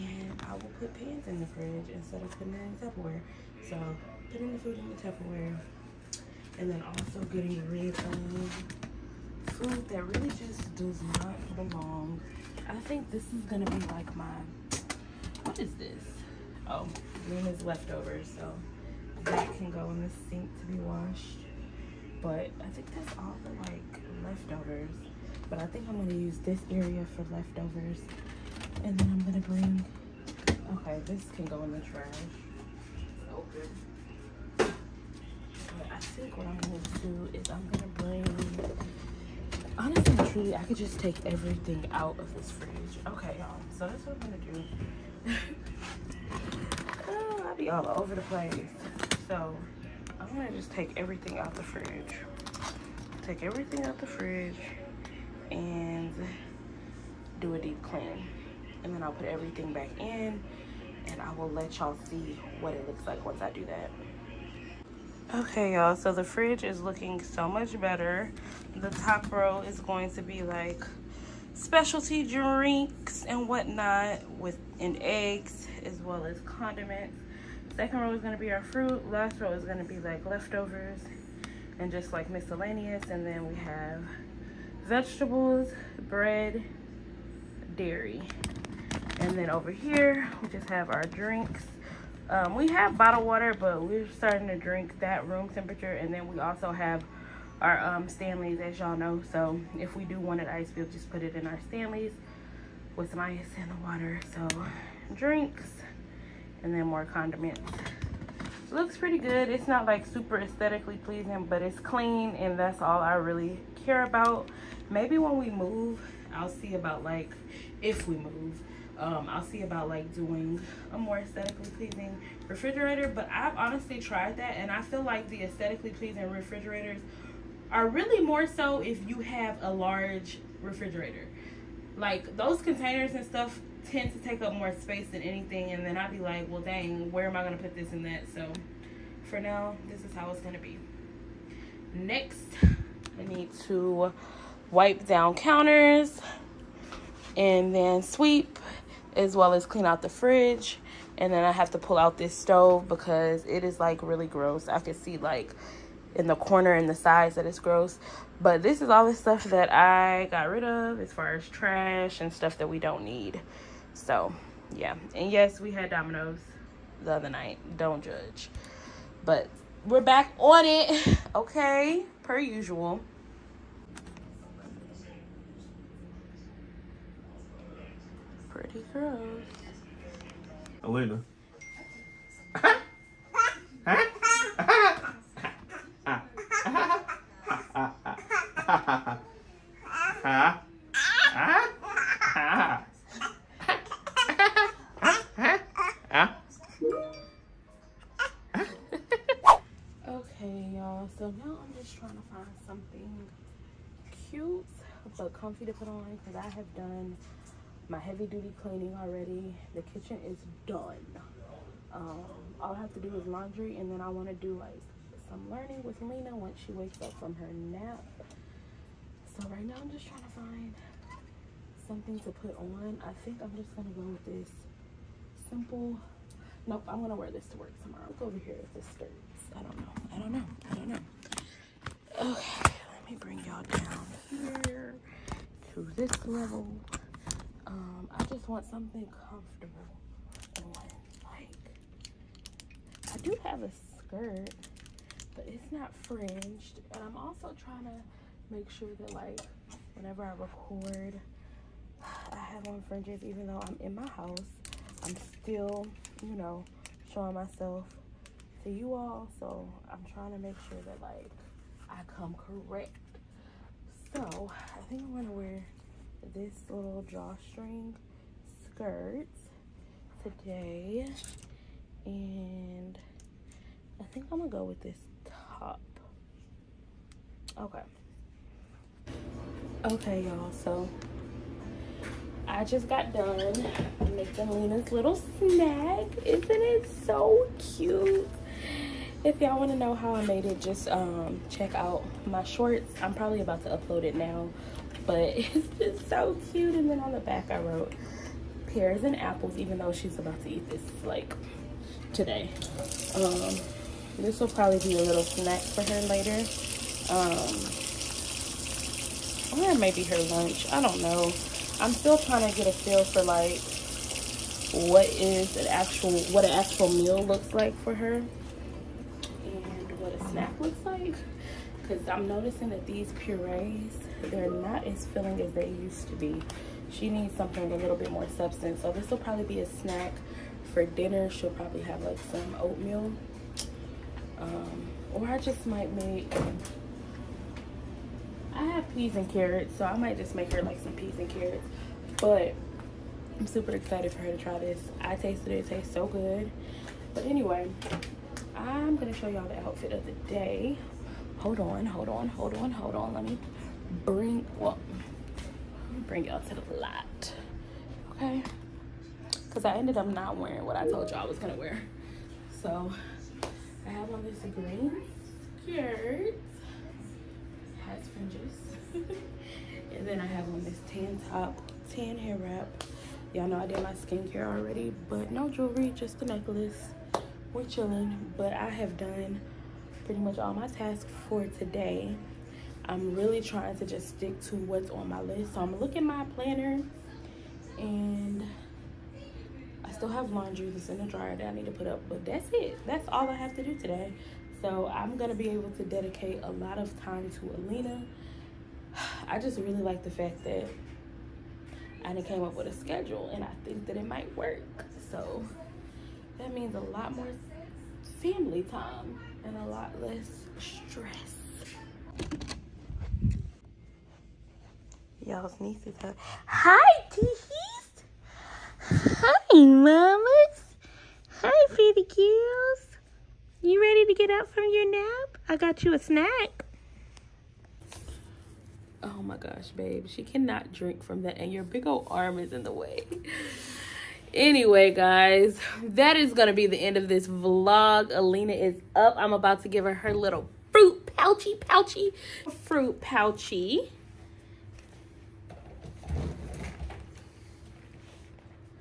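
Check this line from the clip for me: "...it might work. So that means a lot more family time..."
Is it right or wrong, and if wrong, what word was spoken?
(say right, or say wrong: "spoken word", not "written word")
right.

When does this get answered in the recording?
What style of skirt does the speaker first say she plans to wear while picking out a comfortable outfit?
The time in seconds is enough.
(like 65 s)
267 s.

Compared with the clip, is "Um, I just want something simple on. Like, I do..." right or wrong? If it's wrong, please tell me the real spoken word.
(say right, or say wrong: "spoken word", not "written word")
wrong: "comfortable", not "simple".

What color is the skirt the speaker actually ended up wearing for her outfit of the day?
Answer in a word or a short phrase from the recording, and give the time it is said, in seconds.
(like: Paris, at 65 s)
green, at 364 s.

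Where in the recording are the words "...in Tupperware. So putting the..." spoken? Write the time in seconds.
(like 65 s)
2 s.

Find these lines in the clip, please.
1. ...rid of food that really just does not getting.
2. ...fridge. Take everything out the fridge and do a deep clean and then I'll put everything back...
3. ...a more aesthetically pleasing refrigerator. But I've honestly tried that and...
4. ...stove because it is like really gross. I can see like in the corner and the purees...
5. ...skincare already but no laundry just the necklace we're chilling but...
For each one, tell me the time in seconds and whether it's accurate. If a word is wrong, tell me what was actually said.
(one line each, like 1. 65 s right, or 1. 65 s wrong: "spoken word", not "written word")
1. 7 s wrong: "belong", not "getting"
2. 51 s right
3. 120 s right
4. 152 s wrong: "sides", not "purees"
5. 373 s wrong: "jewelry", not "laundry".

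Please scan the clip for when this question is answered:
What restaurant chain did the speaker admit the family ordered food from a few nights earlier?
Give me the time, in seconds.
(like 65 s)
165 s.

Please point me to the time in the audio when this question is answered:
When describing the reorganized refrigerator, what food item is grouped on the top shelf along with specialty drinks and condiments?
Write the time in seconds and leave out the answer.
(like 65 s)
75 s.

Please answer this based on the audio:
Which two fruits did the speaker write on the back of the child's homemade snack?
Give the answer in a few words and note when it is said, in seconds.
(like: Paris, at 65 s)
pears and apples, at 298 s.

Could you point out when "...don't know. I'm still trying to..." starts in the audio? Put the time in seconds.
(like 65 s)
310 s.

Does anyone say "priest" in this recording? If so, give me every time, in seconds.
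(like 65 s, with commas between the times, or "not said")
not said.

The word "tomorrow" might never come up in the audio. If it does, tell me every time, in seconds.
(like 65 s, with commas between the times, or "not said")
227 s.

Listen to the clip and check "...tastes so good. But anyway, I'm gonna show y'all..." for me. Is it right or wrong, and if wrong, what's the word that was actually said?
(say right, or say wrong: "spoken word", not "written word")
right.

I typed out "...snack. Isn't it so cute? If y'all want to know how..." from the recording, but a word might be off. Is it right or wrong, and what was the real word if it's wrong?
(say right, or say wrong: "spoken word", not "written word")
right.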